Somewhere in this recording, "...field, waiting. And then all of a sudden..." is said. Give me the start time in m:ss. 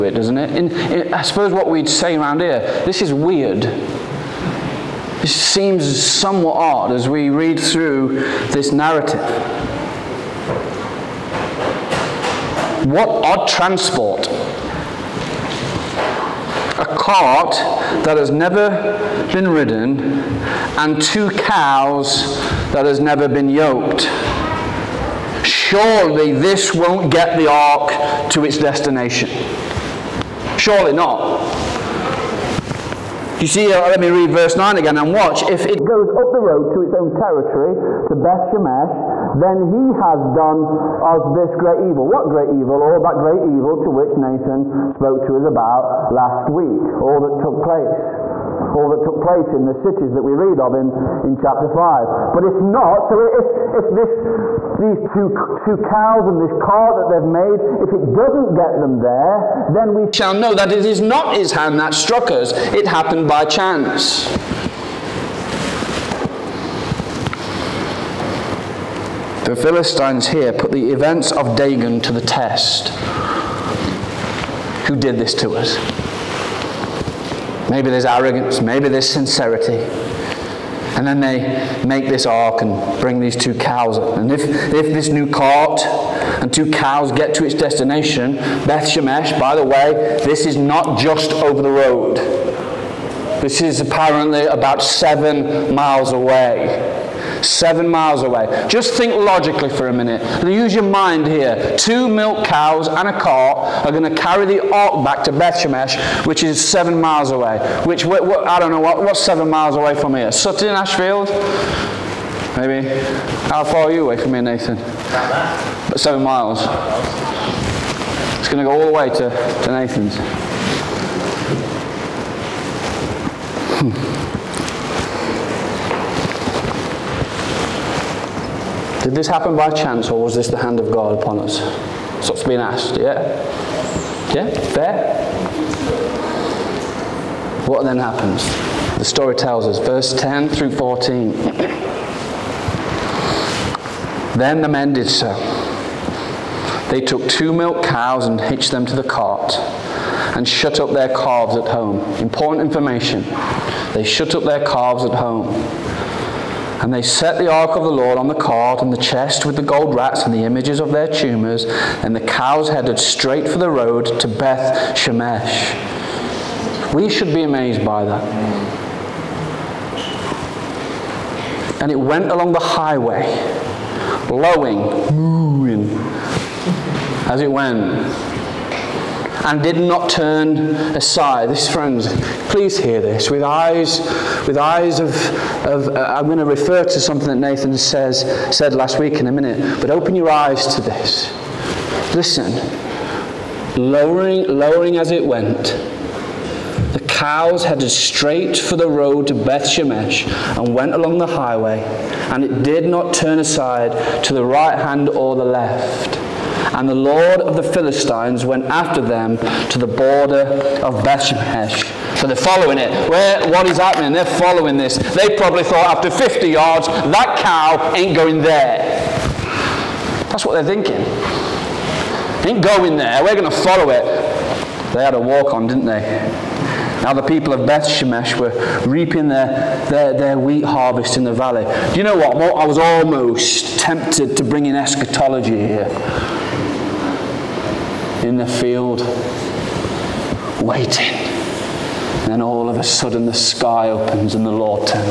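3:58.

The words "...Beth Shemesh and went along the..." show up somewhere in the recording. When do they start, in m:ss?
3:19.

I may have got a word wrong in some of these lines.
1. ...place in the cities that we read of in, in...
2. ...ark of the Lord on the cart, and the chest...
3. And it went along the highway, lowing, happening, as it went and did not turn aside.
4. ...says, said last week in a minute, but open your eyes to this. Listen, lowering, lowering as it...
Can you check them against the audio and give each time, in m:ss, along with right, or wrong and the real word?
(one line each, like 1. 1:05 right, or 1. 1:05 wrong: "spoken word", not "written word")
1. 0:49 right
2. 2:37 right
3. 2:51 wrong: "mooing", not "happening"
4. 3:07 right.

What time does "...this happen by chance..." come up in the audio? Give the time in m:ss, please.
2:09.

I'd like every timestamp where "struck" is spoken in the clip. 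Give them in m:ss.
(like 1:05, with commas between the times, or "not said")
1:01.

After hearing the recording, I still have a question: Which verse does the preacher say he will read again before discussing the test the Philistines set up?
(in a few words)
9.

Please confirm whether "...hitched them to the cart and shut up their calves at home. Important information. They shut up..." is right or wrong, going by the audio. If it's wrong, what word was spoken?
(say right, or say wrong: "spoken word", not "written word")
right.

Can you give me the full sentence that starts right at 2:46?
We should be amazed by that.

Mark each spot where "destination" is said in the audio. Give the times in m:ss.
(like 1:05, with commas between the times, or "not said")
0:28, 1:27.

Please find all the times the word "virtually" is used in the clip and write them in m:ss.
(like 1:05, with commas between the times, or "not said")
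not said.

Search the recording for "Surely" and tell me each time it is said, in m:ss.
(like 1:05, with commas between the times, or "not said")
0:25, 0:30.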